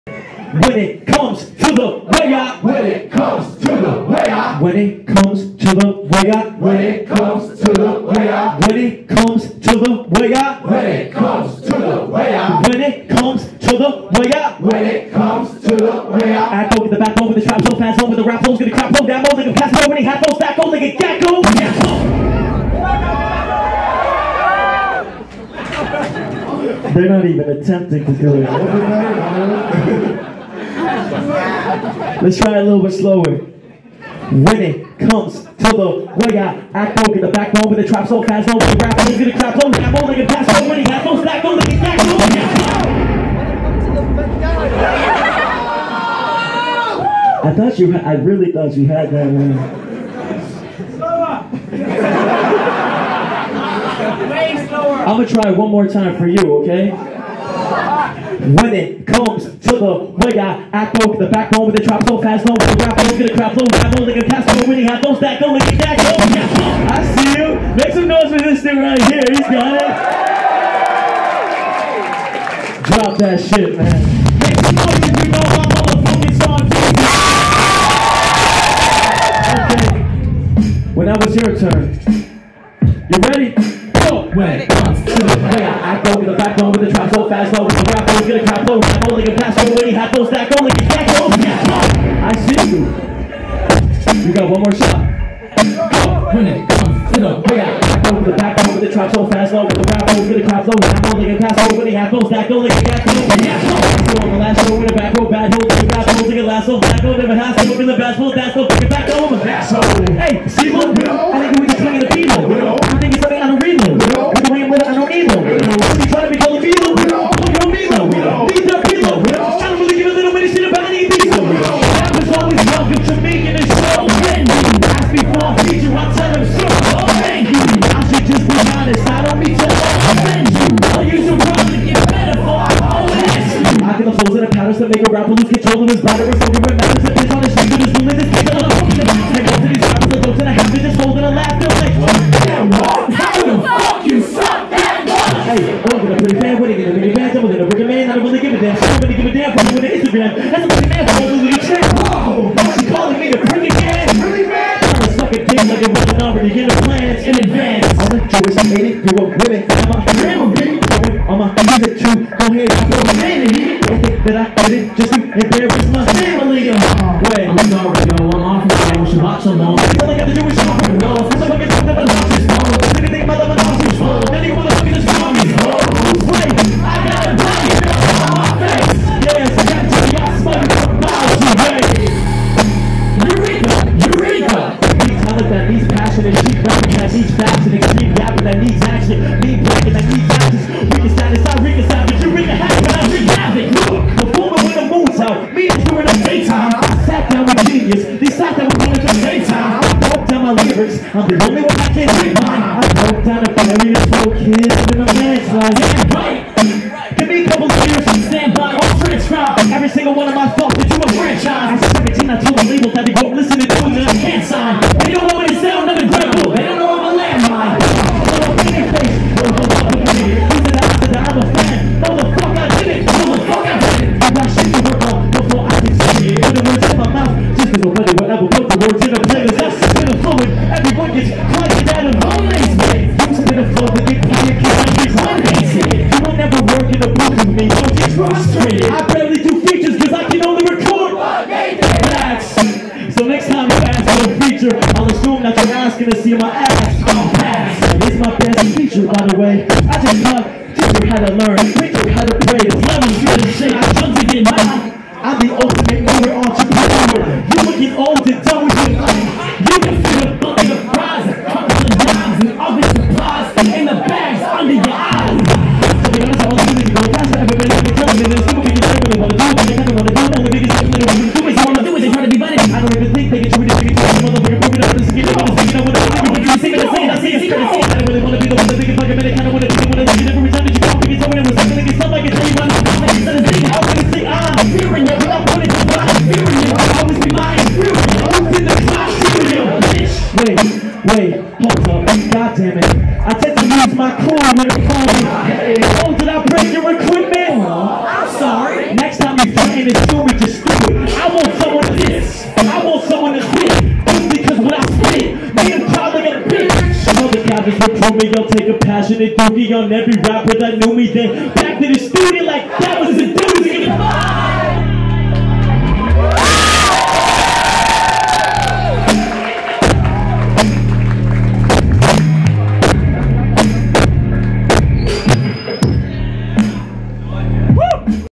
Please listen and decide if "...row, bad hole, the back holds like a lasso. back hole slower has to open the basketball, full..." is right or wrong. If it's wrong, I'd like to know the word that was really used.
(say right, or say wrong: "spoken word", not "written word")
wrong: "never", not "slower".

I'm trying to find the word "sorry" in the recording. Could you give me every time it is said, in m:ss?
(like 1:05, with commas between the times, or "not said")
2:47.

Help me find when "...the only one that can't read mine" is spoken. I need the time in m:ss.
3:21.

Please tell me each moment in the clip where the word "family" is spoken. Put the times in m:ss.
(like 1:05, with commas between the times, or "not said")
2:46, 3:23.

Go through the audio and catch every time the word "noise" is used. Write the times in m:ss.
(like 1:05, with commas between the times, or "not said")
1:08, 1:14.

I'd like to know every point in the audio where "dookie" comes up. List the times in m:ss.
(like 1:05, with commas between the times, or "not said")
5:09.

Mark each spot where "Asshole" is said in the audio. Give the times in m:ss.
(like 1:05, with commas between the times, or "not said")
1:49.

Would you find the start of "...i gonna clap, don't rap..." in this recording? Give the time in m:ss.
0:38.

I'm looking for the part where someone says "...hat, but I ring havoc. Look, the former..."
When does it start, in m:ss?
3:12.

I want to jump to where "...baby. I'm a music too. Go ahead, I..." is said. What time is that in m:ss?
2:40.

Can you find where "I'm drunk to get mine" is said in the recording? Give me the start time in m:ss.
4:13.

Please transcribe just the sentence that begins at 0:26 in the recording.
They're not even attempting to do it.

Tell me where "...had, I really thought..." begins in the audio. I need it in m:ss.
0:47.